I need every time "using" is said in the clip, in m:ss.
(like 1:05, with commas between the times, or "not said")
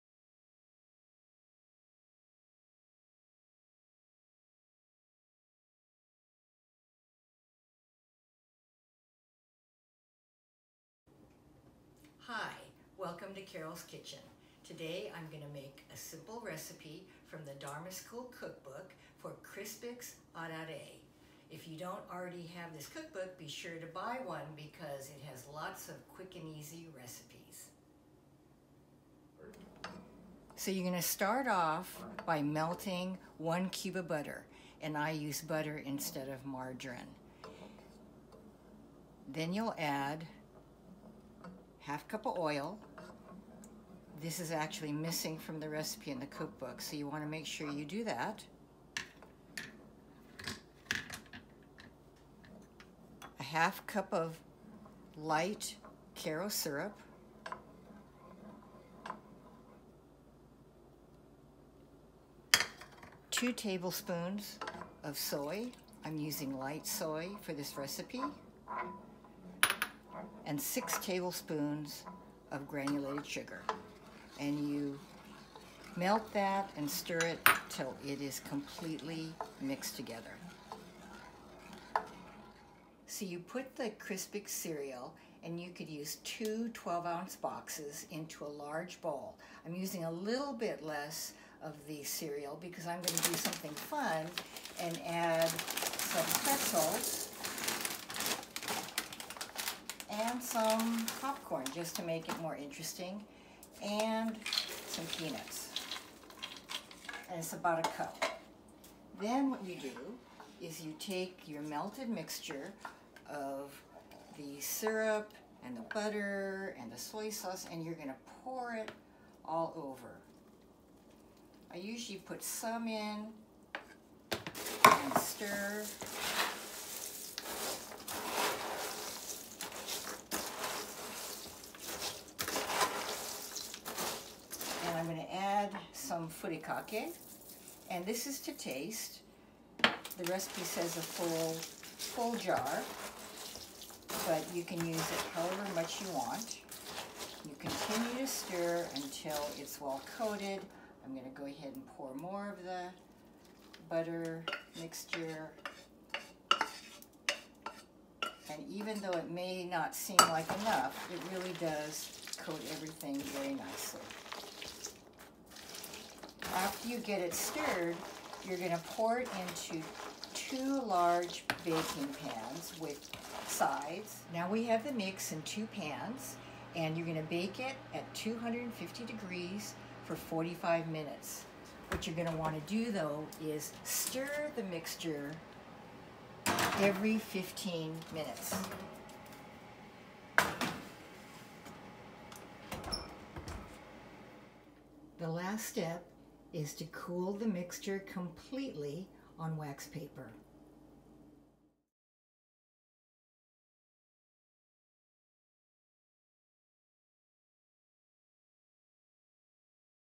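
1:06, 1:29.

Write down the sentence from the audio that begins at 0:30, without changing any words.
So you're going to start off by melting one cube of butter, and I use butter instead of margarine.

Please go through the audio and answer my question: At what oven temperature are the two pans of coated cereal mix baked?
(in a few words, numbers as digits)
250 degrees.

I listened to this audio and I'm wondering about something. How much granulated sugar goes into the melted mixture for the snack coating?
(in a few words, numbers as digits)
6 tablespoons.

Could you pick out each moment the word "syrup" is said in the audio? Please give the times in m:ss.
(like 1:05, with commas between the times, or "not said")
0:56, 1:54.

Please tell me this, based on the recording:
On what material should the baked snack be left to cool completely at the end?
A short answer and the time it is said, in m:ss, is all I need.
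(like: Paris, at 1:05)
wax paper, at 3:19.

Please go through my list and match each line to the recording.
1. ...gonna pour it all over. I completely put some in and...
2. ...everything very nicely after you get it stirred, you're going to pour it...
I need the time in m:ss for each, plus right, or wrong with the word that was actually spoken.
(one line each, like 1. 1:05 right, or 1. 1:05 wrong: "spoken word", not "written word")
1. 1:57 wrong: "usually", not "completely"
2. 2:42 right.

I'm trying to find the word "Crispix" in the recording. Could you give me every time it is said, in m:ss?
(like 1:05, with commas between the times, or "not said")
0:19, 1:23.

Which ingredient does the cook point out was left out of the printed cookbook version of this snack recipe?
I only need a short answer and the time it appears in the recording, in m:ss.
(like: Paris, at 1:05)
half cup of oil, at 0:41.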